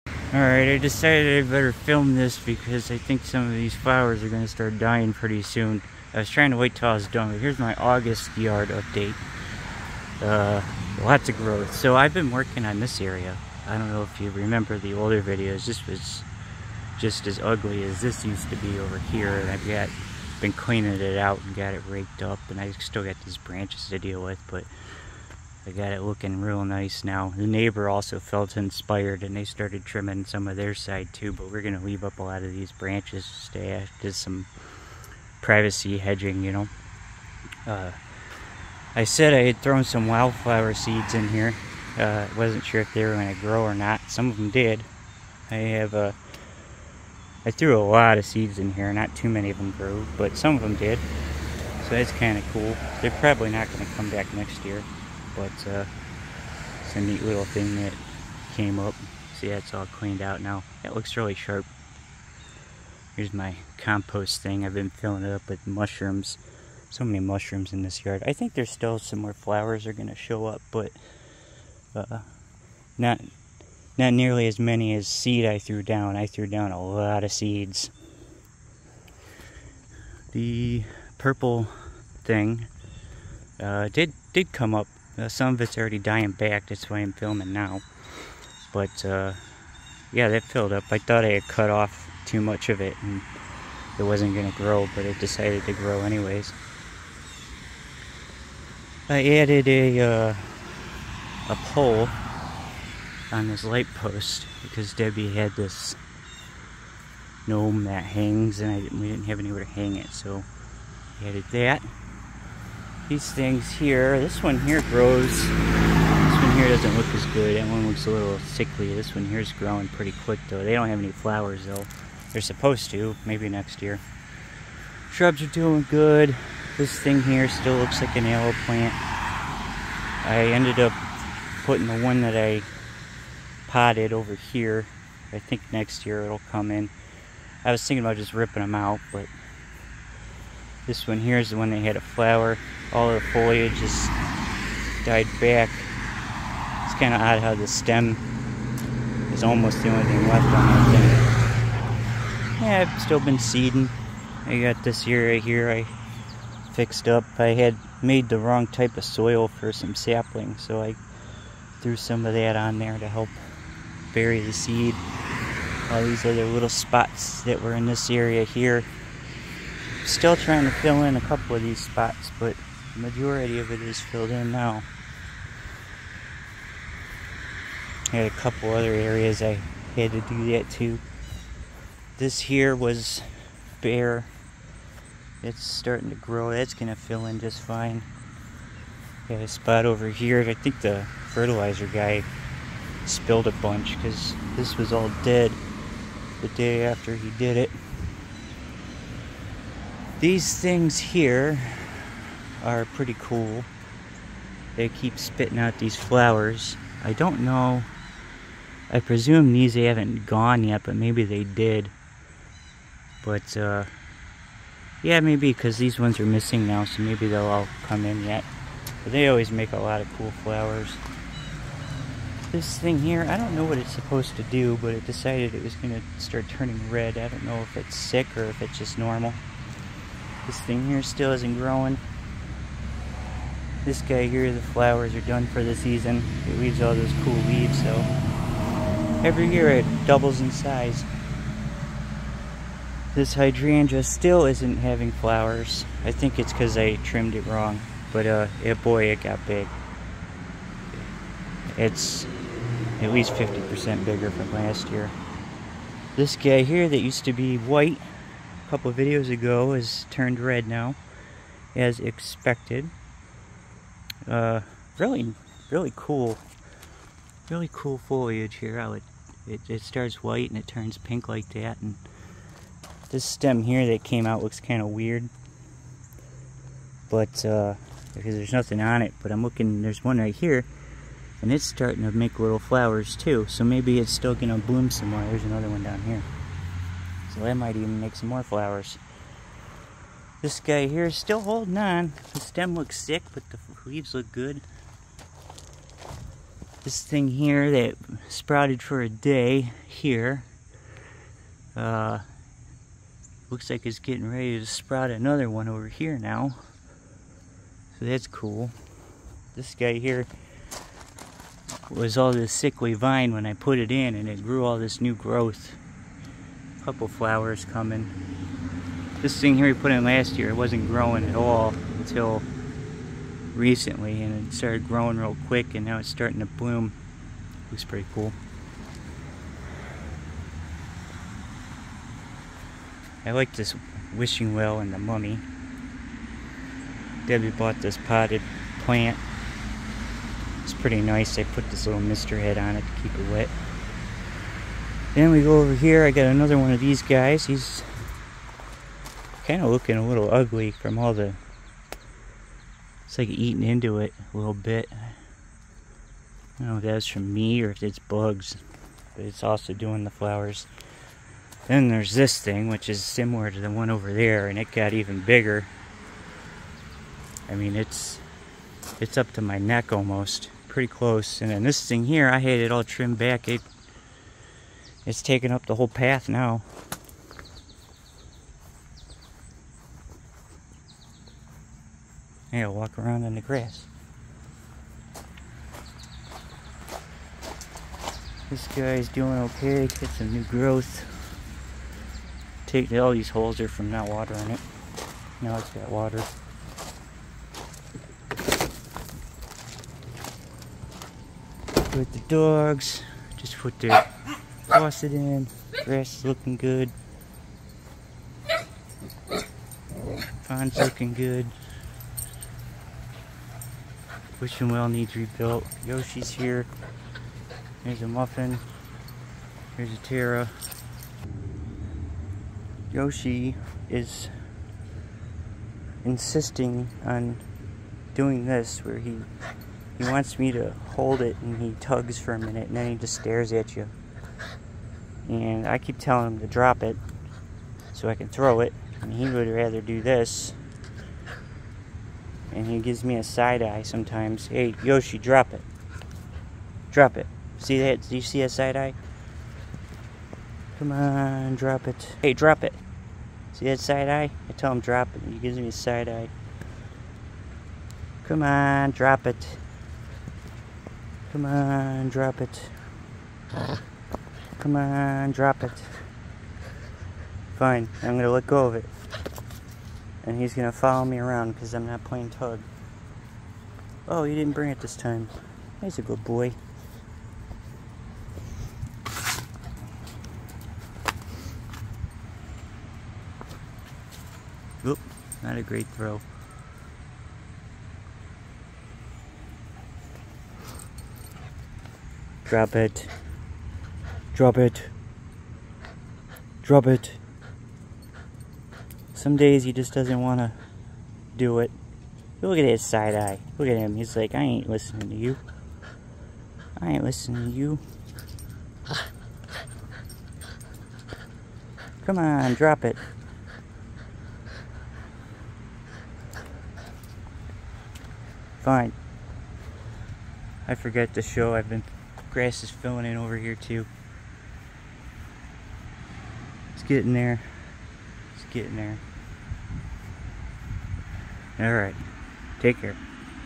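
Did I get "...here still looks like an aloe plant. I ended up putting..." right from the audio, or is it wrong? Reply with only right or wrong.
right.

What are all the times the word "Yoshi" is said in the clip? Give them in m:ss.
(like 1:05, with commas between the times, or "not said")
6:55, 7:02, 7:24.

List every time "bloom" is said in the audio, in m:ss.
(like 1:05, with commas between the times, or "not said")
4:44, 5:26.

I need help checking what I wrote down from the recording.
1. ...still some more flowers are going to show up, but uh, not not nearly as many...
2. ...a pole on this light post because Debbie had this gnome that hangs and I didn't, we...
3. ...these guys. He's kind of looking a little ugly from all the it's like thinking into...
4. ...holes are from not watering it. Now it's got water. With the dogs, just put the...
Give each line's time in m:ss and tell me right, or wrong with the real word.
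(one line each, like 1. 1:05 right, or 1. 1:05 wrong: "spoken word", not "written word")
1. 1:08 right
2. 1:41 right
3. 5:46 wrong: "eating", not "thinking"
4. 6:33 right.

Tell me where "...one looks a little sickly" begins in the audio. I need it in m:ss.
1:57.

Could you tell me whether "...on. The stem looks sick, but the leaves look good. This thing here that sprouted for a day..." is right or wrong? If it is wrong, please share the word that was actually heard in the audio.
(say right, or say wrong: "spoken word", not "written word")
right.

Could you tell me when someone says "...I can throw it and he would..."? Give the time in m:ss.
7:18.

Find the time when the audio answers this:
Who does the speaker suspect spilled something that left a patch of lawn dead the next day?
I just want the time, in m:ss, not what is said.
3:11.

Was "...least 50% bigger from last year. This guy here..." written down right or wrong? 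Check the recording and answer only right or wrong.
right.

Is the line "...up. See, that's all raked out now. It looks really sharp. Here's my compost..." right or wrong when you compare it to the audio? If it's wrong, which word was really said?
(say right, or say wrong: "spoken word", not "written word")
wrong: "cleaned", not "raked".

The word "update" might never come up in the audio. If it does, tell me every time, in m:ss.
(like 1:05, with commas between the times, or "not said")
0:08.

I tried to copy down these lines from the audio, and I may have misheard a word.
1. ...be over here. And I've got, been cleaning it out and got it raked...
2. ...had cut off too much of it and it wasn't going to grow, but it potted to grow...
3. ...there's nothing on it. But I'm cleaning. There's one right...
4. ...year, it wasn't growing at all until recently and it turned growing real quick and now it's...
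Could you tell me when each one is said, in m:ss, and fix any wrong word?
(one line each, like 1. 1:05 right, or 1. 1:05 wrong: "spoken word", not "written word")
1. 0:18 right
2. 1:31 wrong: "decided", not "potted"
3. 4:38 wrong: "looking", not "cleaning"
4. 5:20 wrong: "started", not "turned".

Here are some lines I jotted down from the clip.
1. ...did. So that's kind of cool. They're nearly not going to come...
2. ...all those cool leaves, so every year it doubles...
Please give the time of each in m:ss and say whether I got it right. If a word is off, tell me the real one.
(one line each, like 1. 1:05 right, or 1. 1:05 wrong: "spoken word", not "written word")
1. 0:50 wrong: "probably", not "nearly"
2. 3:56 right.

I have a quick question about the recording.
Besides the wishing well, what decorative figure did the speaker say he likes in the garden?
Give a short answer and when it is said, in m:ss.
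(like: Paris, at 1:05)
The mummy, at 5:34.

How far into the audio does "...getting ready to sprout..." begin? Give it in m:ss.
5:03.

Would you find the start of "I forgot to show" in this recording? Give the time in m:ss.
8:40.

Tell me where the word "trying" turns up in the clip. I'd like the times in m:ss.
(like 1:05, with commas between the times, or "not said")
0:06, 2:50.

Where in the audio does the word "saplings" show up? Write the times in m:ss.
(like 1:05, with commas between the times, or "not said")
2:39.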